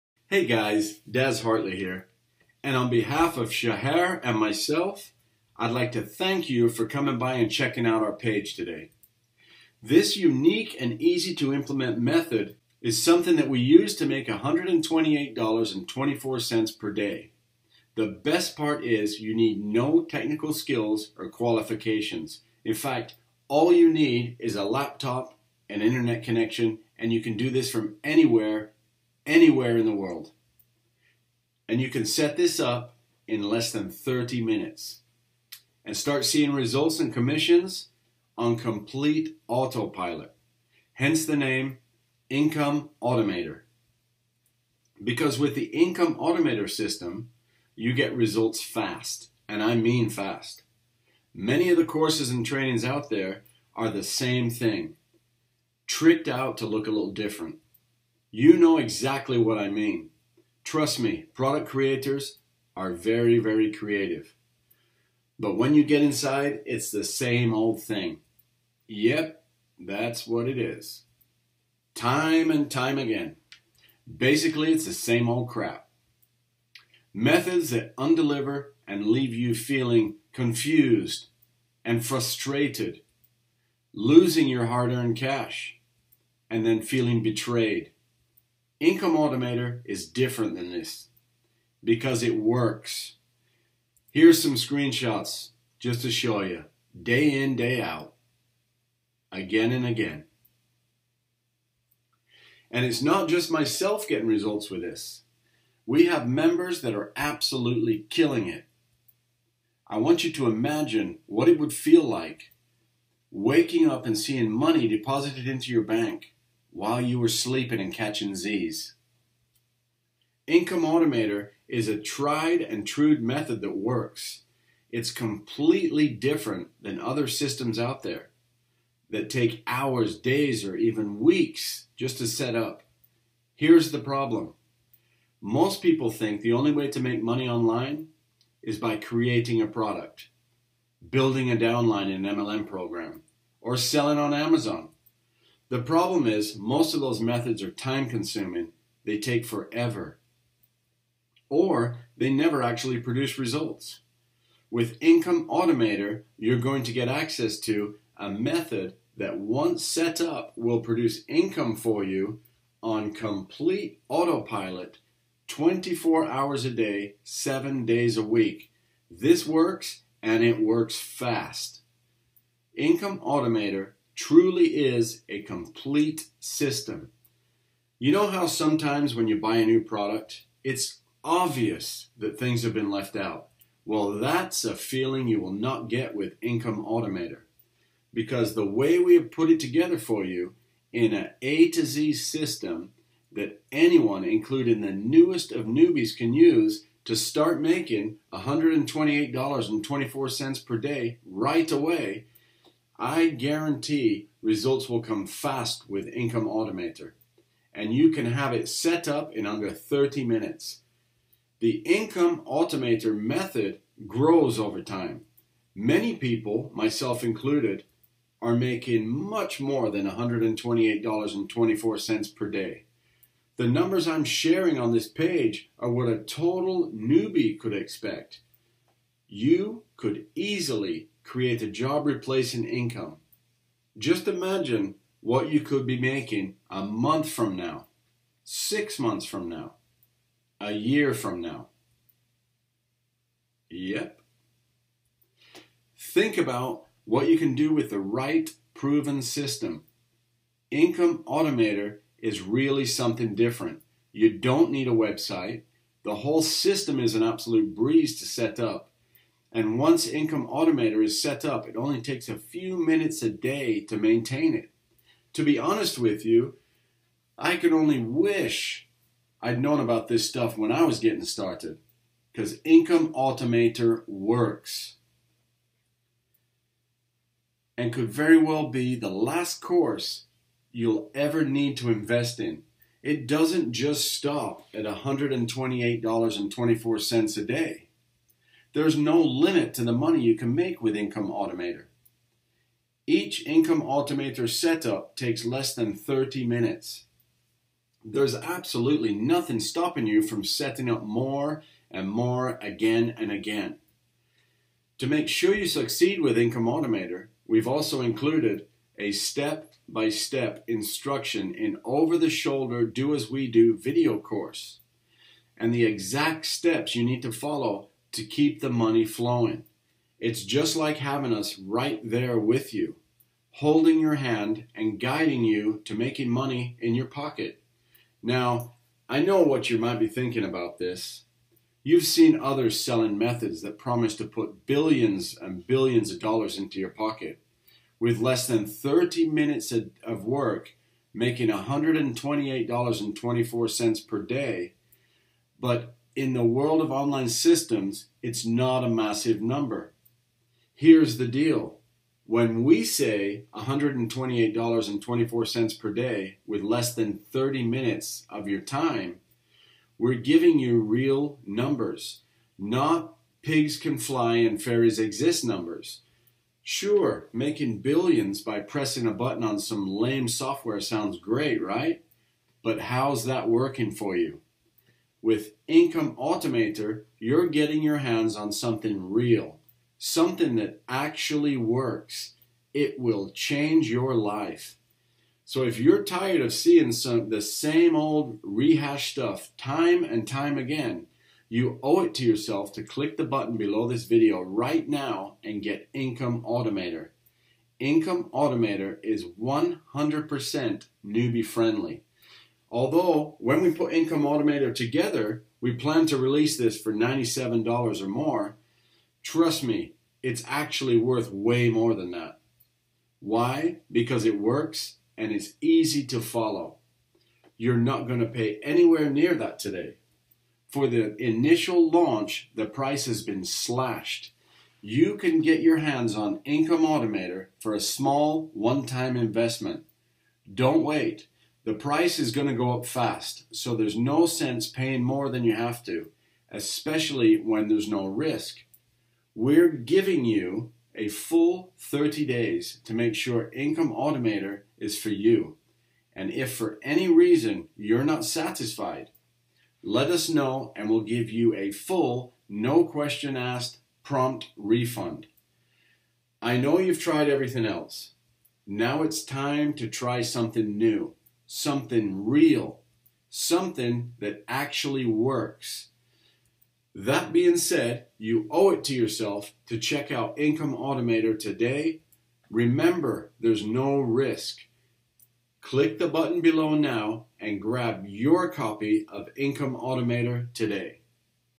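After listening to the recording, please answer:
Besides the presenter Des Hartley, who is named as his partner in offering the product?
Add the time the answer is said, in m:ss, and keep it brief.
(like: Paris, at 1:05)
Shahar, at 0:03.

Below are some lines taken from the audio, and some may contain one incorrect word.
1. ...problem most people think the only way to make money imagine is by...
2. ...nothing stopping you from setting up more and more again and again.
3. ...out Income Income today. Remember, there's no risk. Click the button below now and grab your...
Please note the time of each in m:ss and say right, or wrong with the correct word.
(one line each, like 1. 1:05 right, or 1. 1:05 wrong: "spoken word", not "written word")
1. 2:13 wrong: "online", not "imagine"
2. 4:59 right
3. 7:50 wrong: "Automater", not "Income".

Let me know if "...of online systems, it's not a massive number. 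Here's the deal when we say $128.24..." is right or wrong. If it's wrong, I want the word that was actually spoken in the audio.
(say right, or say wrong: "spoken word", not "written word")
right.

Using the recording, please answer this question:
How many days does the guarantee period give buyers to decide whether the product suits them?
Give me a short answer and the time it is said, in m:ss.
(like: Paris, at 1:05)
30, at 7:21.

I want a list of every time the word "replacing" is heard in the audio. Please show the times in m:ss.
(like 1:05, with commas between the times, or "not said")
3:52.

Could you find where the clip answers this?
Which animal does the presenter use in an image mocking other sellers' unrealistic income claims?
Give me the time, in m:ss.
6:03.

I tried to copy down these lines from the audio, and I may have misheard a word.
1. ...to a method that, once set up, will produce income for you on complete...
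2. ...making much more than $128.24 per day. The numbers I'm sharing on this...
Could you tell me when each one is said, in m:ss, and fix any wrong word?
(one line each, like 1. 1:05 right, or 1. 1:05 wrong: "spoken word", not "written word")
1. 2:37 right
2. 3:38 right.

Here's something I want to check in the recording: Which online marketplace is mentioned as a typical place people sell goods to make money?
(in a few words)
Amazon.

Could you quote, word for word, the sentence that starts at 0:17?
The best part is you need no technical skills or qualifications.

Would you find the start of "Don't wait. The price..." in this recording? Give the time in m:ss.
7:10.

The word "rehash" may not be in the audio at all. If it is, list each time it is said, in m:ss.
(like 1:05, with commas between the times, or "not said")
6:28.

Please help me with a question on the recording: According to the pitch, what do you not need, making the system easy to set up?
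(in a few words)
a website.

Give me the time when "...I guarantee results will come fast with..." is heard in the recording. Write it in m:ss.
3:23.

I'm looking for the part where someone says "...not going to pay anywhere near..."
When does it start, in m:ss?
6:57.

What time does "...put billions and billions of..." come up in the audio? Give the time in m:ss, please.
5:34.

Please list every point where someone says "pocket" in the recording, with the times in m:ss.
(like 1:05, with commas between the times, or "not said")
5:27, 5:36.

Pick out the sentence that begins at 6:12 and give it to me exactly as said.
But how's that working for you?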